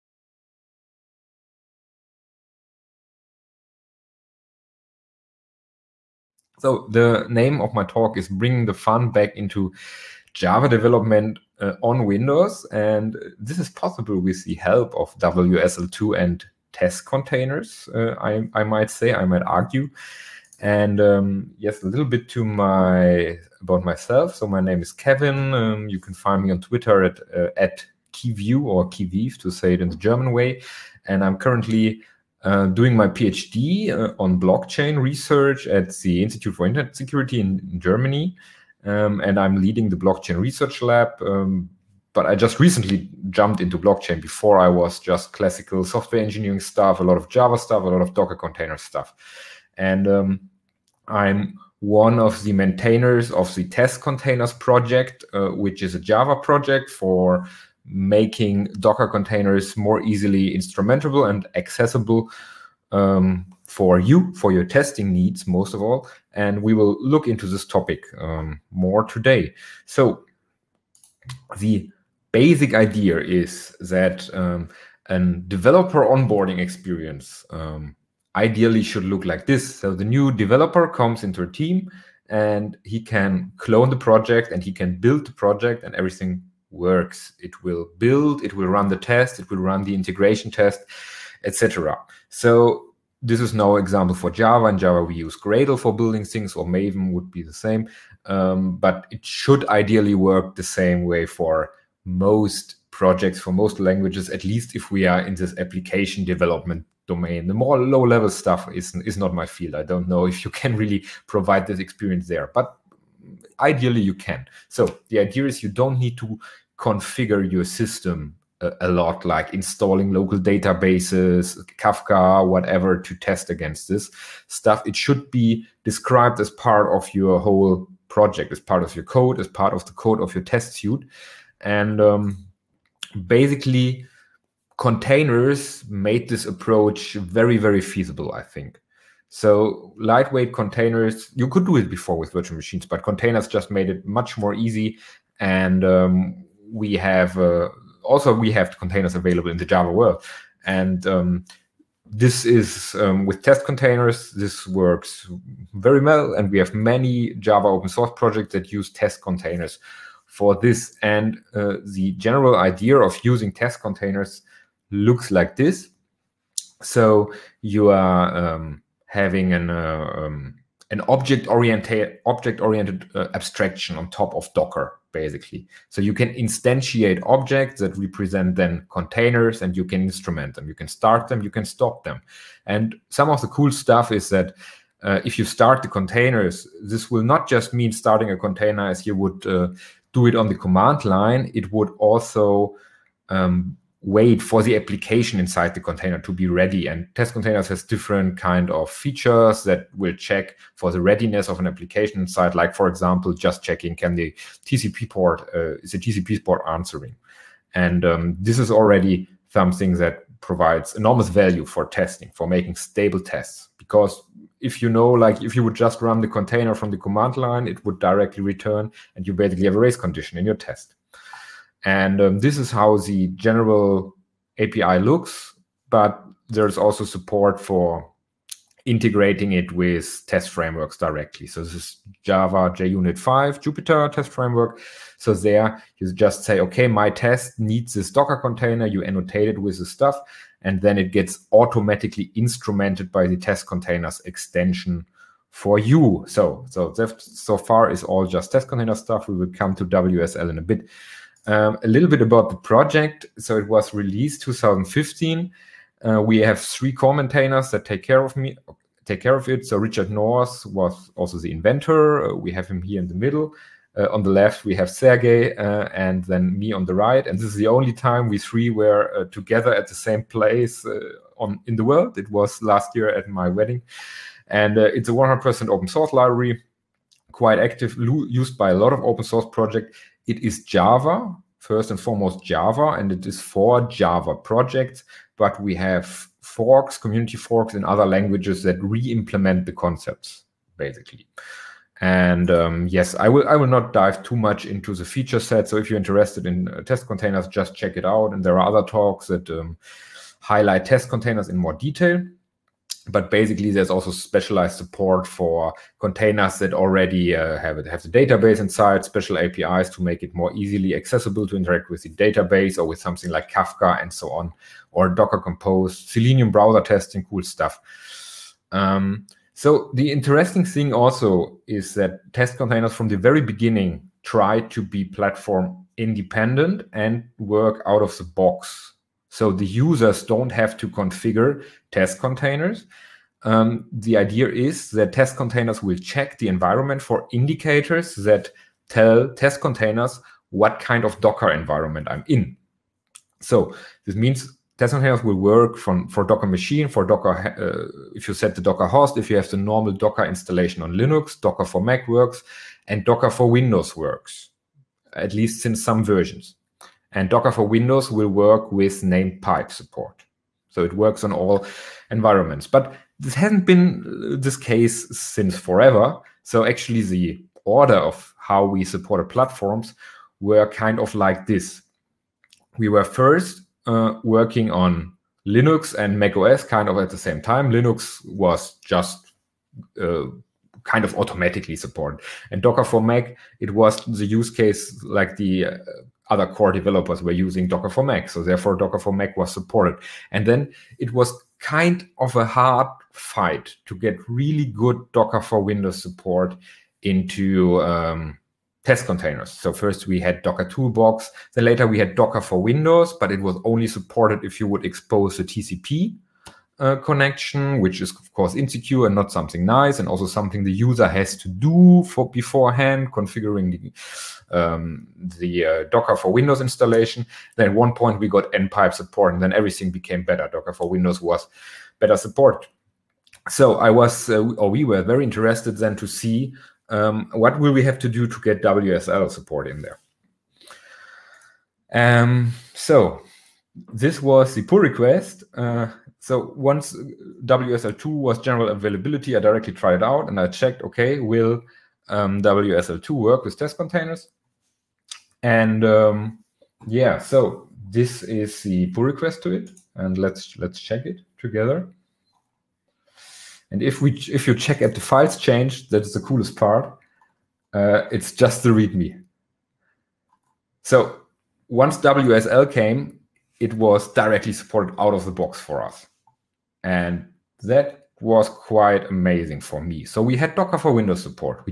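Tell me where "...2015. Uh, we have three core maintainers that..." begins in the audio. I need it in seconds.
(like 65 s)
254 s.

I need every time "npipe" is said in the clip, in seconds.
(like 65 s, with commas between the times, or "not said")
418 s.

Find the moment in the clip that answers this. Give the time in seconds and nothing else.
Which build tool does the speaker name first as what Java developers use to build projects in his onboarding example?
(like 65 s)
95 s.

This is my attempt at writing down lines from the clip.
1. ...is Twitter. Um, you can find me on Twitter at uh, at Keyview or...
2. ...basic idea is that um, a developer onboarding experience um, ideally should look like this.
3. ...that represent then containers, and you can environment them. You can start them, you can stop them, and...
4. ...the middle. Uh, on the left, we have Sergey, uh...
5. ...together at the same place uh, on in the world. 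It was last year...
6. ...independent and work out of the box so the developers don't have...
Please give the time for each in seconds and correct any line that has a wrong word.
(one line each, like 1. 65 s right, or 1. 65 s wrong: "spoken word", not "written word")
1. 24 s wrong: "Kevin", not "Twitter"
2. 72 s right
3. 177 s wrong: "instrument", not "environment"
4. 263 s right
5. 269 s right
6. 325 s wrong: "users", not "developers".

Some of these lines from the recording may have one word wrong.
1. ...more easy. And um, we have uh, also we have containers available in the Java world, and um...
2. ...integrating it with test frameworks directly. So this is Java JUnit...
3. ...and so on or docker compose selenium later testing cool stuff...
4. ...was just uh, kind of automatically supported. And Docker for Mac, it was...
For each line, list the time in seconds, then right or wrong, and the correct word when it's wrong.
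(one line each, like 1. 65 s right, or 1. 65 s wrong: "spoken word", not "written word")
1. 144 s right
2. 228 s right
3. 314 s wrong: "browser", not "later"
4. 378 s right.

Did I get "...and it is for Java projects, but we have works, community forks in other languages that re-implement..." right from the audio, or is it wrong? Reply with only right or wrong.
wrong.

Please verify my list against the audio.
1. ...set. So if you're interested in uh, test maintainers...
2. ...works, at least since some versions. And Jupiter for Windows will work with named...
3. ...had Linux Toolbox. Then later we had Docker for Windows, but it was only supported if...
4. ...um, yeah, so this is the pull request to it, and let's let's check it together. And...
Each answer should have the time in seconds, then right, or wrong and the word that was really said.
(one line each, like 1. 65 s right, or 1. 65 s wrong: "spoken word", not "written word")
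1. 295 s wrong: "containers", not "maintainers"
2. 353 s wrong: "Docker", not "Jupiter"
3. 400 s wrong: "Docker", not "Linux"
4. 445 s right.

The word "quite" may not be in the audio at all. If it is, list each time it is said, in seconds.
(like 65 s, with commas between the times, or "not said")
277 s, 468 s.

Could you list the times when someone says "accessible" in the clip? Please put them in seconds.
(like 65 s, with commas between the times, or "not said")
61 s, 310 s.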